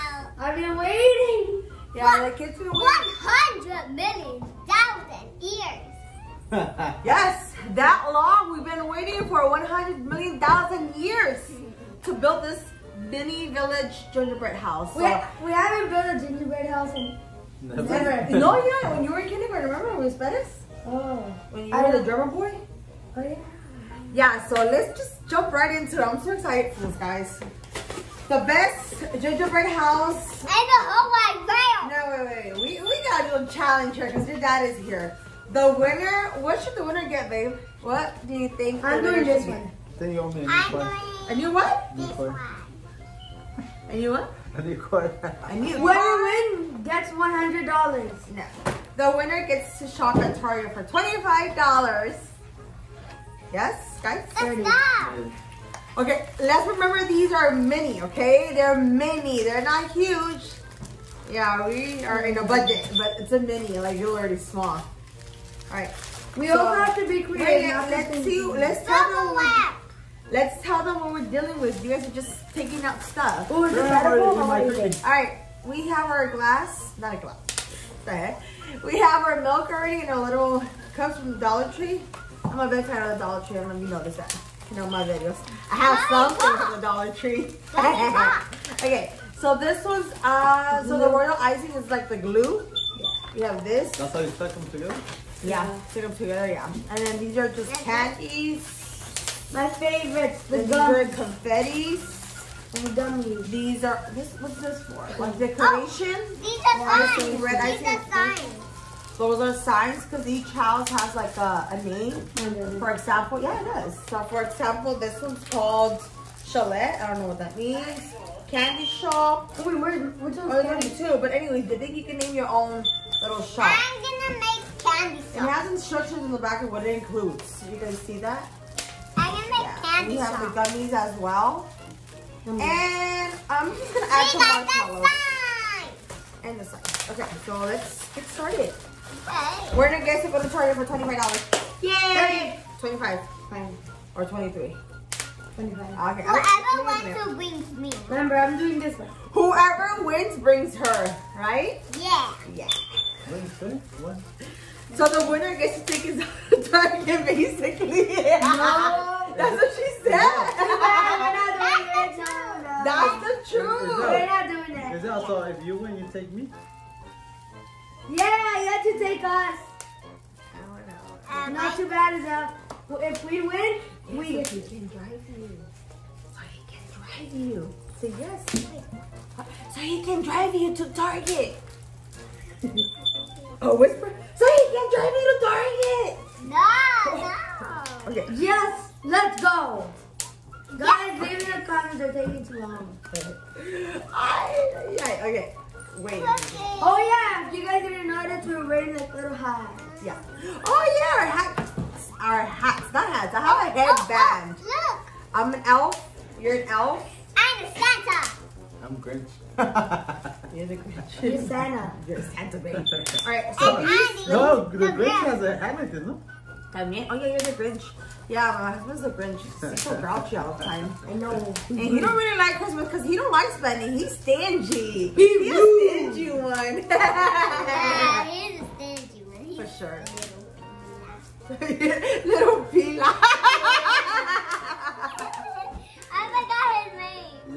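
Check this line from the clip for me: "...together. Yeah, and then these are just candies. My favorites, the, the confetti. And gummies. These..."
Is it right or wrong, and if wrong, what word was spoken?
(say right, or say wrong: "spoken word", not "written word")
right.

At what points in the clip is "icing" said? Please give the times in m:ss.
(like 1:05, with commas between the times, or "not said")
1:31.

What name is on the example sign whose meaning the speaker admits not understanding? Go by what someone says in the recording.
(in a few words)
Chalet.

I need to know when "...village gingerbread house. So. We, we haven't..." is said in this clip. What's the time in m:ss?
0:13.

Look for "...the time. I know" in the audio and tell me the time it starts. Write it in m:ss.
3:40.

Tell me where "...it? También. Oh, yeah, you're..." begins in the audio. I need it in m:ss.
3:36.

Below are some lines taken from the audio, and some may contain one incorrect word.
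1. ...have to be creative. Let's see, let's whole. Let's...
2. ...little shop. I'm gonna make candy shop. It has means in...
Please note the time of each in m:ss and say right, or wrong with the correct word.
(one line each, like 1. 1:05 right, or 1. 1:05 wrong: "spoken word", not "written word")
1. 1:06 wrong: "tackle", not "whole"
2. 2:03 wrong: "instructions", not "means".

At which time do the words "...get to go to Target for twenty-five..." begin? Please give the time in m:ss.
2:20.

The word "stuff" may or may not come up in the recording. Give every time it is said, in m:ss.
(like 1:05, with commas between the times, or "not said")
1:13.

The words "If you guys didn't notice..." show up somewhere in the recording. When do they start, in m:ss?
3:17.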